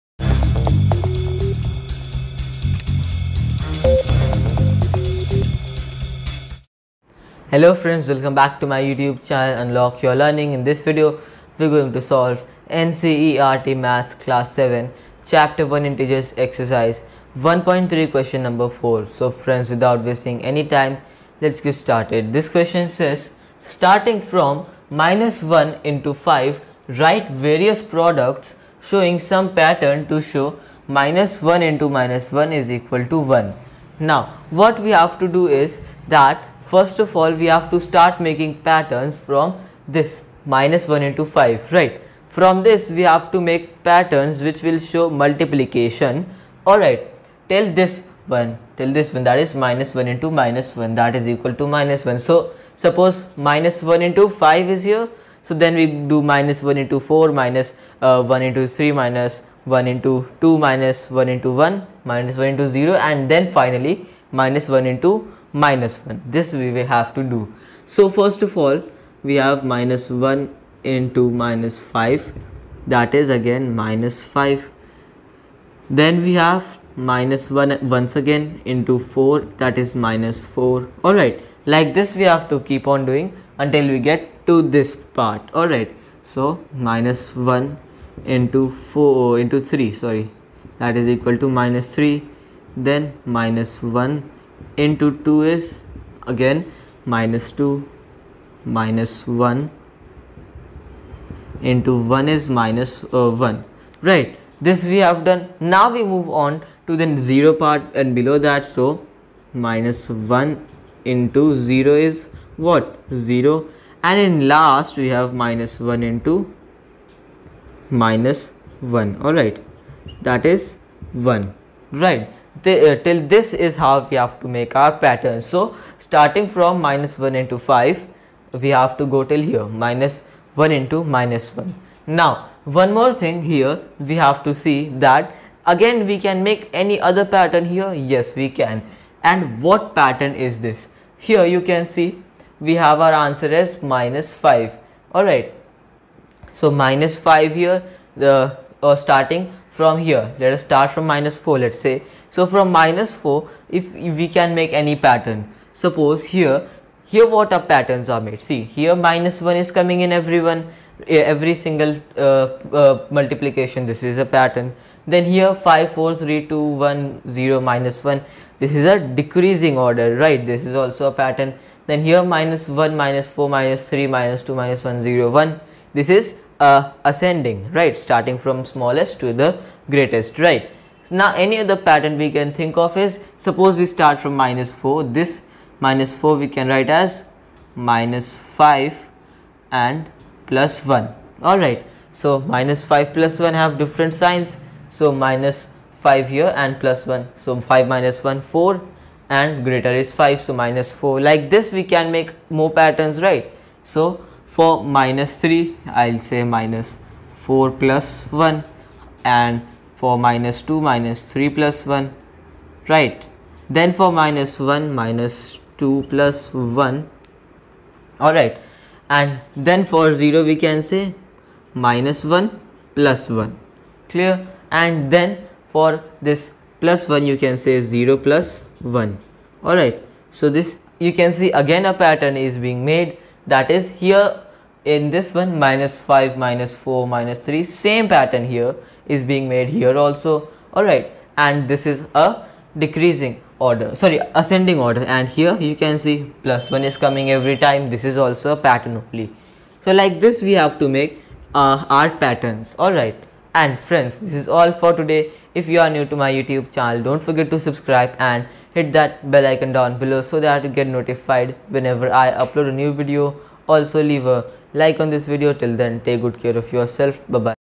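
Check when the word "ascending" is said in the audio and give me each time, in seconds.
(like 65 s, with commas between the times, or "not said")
177 s, 244 s.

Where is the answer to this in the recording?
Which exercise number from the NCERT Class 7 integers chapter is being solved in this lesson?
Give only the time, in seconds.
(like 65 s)
16 s.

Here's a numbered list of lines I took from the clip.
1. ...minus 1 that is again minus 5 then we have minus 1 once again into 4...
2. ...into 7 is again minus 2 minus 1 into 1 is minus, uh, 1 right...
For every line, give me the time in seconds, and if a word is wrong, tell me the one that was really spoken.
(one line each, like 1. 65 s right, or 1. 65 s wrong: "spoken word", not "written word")
1. 71 s wrong: "5", not "1"
2. 94 s wrong: "2", not "7".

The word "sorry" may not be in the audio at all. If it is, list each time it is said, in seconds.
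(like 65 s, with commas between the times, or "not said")
90 s, 243 s.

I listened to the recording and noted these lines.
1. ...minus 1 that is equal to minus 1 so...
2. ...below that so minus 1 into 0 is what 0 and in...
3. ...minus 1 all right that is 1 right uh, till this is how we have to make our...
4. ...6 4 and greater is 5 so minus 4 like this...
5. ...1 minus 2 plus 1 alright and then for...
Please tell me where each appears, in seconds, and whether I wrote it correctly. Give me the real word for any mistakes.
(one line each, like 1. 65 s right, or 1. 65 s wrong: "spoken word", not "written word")
1. 50 s right
2. 108 s right
3. 118 s right
4. 198 s wrong: "1", not "6"
5. 214 s right.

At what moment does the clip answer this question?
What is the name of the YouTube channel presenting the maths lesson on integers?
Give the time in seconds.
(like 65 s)
9 s.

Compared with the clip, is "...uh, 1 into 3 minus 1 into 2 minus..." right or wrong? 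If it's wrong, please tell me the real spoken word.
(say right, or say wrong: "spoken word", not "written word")
right.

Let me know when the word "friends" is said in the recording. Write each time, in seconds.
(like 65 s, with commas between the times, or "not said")
7 s, 19 s, 253 s.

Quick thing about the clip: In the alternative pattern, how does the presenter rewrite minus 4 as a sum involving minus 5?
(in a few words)
minus 5 plus 1.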